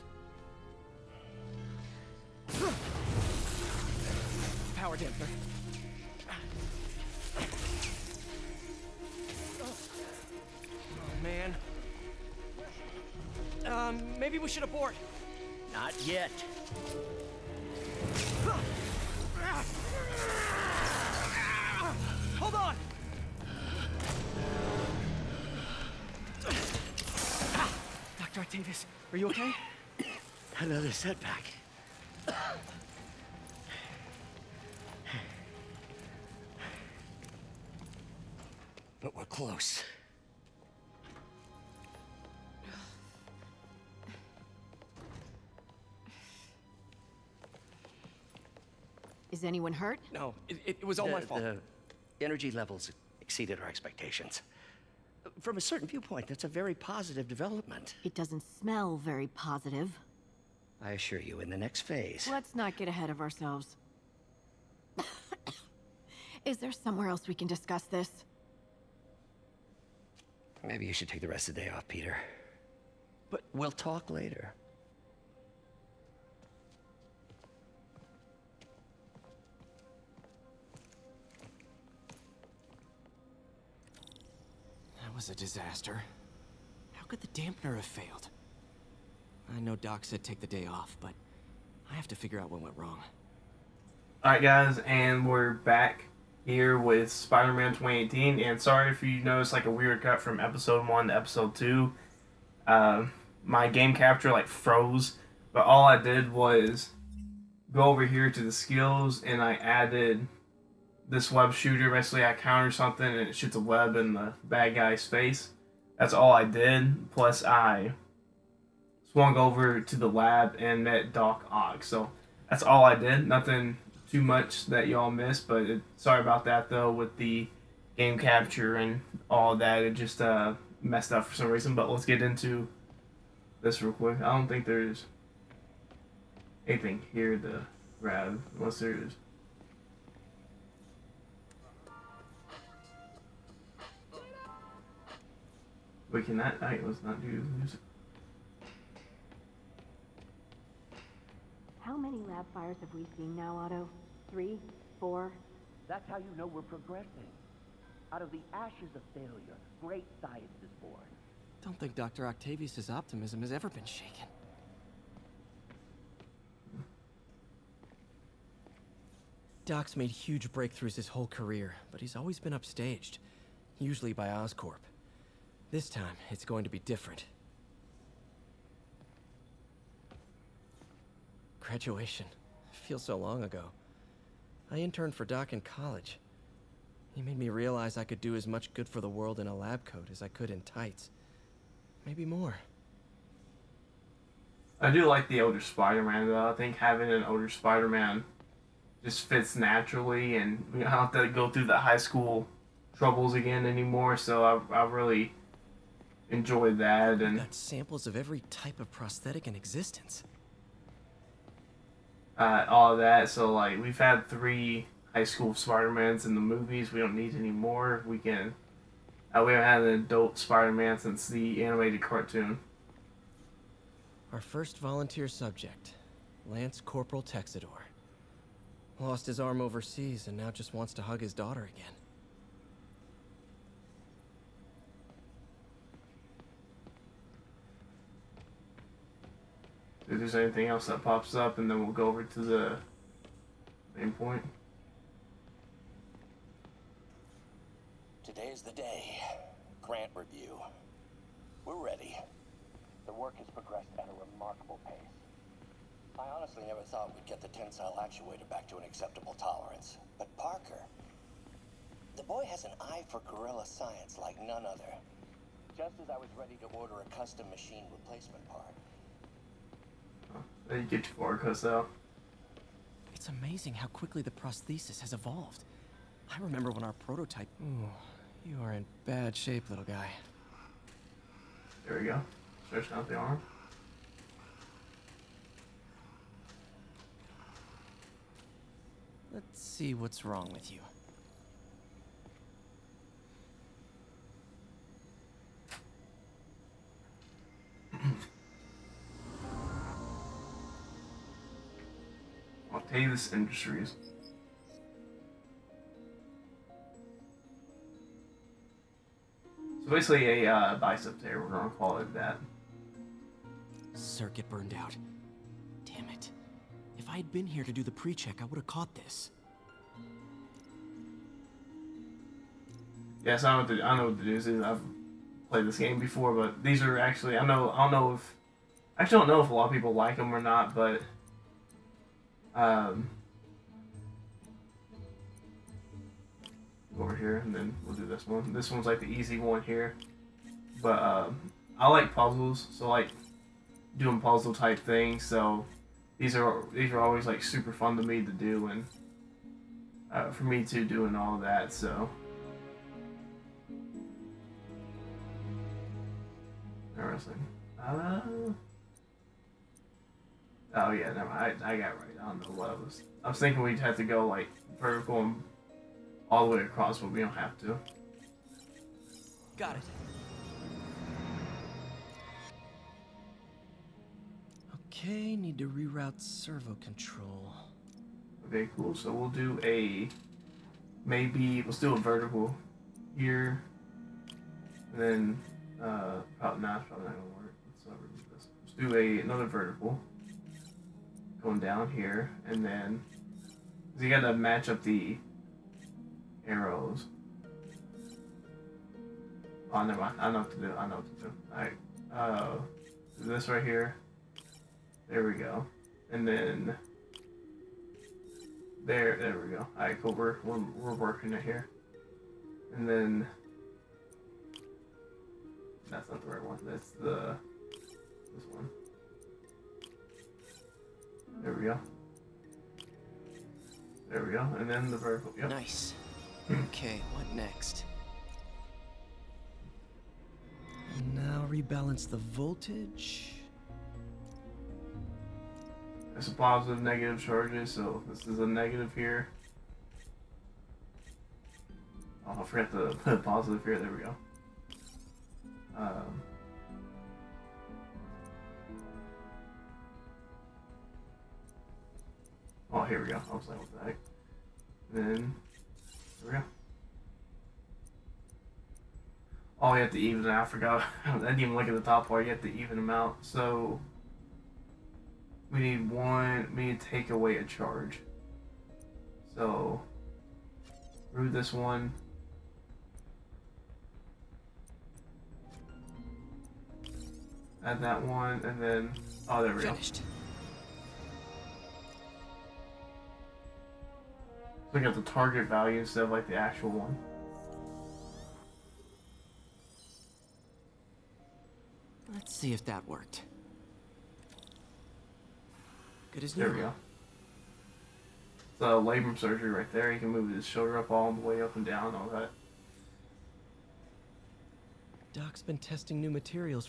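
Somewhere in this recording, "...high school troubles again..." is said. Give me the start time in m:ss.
3:21.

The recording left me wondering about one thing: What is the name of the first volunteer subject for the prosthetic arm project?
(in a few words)
Lance Corporal Texidor.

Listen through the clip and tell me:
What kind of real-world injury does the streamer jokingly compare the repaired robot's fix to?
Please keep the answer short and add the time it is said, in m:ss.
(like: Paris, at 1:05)
labrum surgery, at 8:18.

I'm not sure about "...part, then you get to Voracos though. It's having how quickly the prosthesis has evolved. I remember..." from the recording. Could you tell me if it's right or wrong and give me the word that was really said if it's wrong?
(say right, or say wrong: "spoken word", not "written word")
wrong: "amazing", not "having".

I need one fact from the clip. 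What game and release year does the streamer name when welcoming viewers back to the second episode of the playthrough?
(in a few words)
Spider-Man 2018.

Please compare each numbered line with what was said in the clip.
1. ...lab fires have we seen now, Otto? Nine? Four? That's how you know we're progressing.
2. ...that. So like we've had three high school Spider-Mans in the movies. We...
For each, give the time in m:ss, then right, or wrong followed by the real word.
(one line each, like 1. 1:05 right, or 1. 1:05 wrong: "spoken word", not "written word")
1. 2:32 wrong: "Three", not "Nine"
2. 3:32 right.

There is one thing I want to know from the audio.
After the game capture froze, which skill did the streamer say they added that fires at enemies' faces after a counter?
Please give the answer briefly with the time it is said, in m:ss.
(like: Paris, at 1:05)
web shooter, at 1:51.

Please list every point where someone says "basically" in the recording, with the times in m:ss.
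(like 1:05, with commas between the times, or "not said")
1:51, 5:09.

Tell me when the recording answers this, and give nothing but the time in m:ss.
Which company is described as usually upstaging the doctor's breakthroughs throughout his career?
2:54.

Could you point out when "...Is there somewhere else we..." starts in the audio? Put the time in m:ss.
1:06.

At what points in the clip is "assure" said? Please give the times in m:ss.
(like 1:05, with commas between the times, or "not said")
1:00.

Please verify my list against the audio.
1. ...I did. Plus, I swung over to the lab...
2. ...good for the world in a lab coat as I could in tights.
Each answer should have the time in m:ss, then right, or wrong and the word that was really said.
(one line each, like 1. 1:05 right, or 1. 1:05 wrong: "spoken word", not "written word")
1. 1:56 right
2. 3:08 right.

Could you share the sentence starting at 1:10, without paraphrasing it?
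Maybe you should take the rest of the day off, Peter.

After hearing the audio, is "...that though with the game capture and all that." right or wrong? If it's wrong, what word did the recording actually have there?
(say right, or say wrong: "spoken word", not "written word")
right.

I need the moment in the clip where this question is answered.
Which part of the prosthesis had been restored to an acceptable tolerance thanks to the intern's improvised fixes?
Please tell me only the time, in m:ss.
4:17.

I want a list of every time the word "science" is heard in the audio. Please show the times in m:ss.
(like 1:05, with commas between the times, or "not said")
2:40, 4:23.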